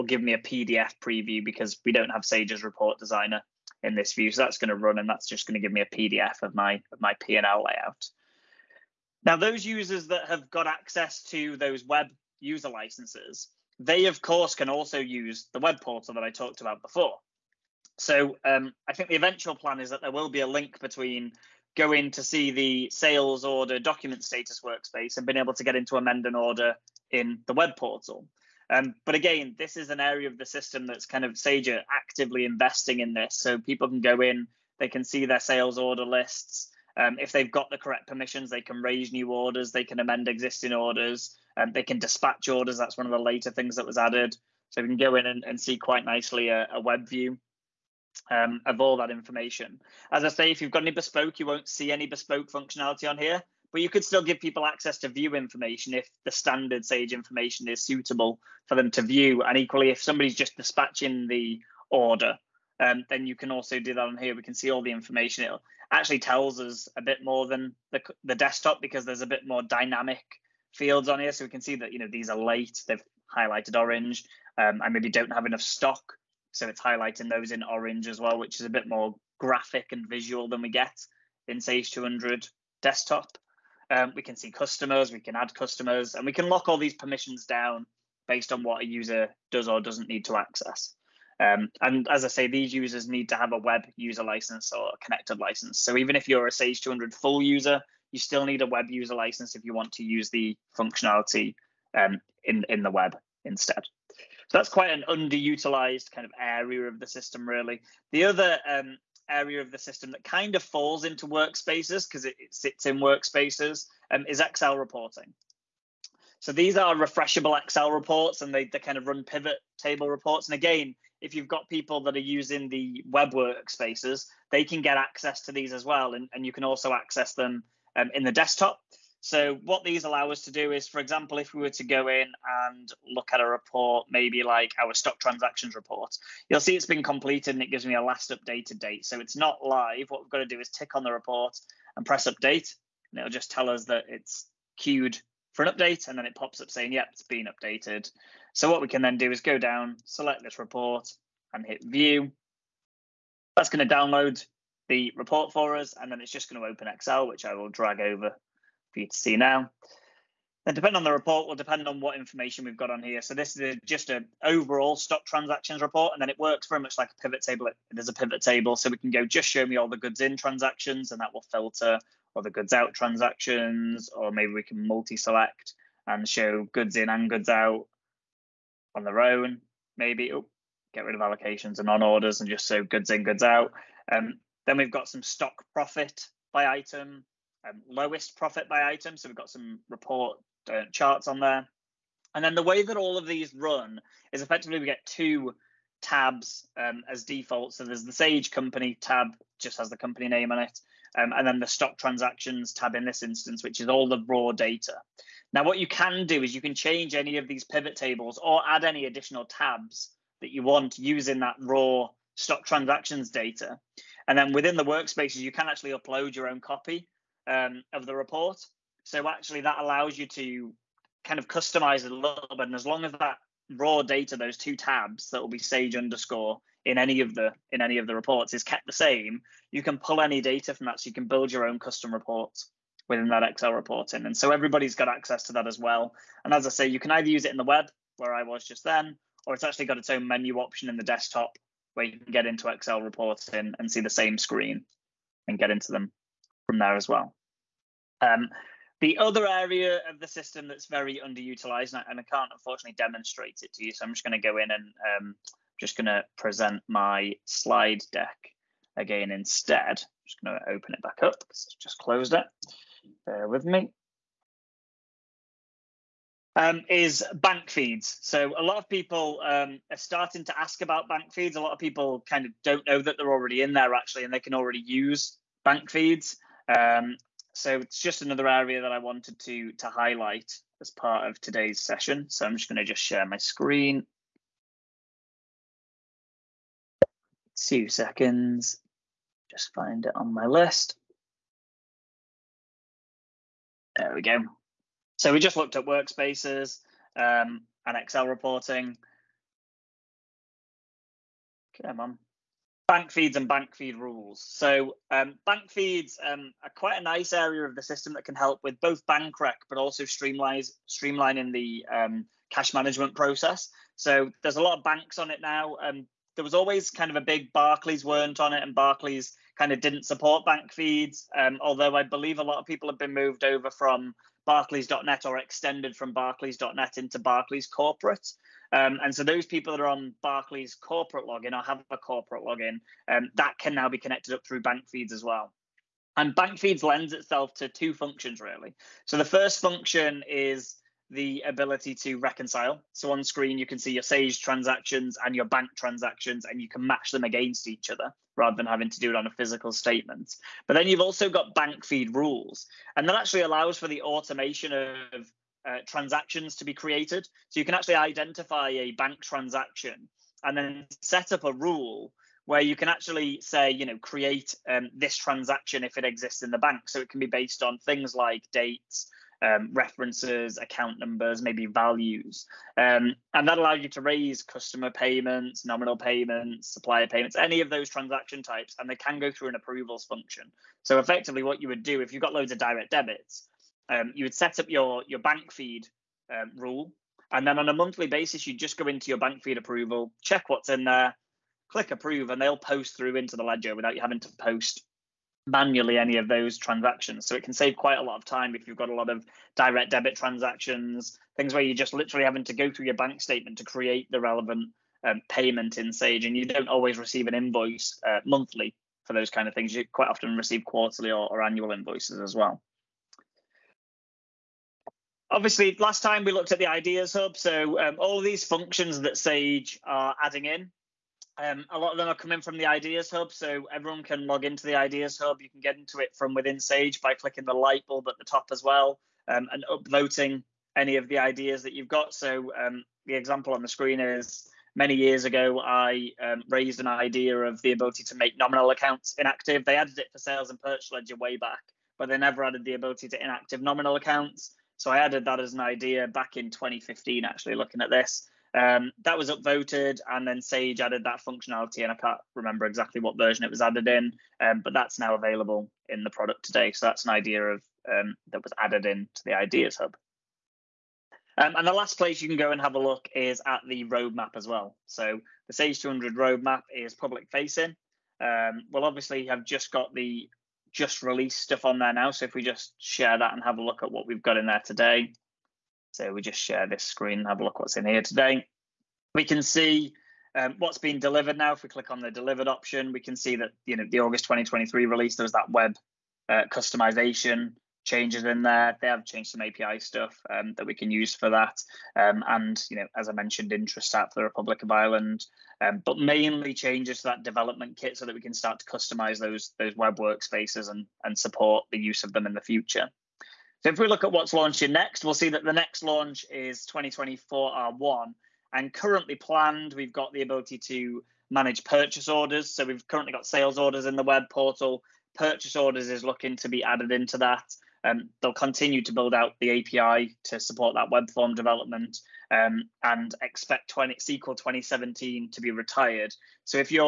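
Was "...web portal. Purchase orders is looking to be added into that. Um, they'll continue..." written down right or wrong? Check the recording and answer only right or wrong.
right.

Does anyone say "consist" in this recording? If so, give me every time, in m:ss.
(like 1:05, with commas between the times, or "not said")
not said.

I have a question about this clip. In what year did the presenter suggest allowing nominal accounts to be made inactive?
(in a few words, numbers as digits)
2015.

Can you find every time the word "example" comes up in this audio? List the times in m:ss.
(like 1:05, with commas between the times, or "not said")
2:10, 7:13.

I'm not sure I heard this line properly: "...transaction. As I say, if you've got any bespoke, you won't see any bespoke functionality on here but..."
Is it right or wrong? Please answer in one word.
wrong.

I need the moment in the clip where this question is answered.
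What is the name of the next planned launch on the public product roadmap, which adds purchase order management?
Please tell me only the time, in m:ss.
8:26.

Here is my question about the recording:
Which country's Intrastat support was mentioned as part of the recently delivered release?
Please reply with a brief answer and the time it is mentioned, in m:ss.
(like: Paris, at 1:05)
Republic of Ireland, at 8:14.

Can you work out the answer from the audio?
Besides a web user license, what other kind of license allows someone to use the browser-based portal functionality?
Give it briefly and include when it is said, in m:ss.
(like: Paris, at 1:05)
connected license, at 1:35.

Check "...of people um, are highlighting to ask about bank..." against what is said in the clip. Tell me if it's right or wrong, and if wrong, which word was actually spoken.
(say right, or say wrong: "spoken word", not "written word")
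wrong: "starting", not "highlighting".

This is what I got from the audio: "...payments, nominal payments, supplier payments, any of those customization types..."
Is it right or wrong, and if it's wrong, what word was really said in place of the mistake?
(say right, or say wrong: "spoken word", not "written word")
wrong: "transaction", not "customization".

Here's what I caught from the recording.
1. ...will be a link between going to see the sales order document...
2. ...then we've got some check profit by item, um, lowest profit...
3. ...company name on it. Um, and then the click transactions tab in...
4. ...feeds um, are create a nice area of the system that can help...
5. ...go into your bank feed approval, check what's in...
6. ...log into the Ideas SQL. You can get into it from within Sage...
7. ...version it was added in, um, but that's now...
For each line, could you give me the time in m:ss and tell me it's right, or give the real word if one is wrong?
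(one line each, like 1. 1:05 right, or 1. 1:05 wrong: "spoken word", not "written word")
1. 0:20 right
2. 3:04 wrong: "stock", not "check"
3. 3:19 wrong: "stock", not "click"
4. 5:05 wrong: "quite", not "create"
5. 6:28 right
6. 7:04 wrong: "Hub", not "SQL"
7. 7:33 right.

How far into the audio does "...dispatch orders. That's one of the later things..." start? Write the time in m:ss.
0:41.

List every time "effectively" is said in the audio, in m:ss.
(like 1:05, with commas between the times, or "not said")
3:14, 6:20.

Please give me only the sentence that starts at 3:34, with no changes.
And then within the workspaces, you can actually upload your own copy um, of the report.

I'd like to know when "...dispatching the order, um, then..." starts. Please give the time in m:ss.
1:00.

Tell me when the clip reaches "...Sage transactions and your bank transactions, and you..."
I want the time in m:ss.
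5:44.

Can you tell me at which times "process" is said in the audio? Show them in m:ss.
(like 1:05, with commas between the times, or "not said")
5:13.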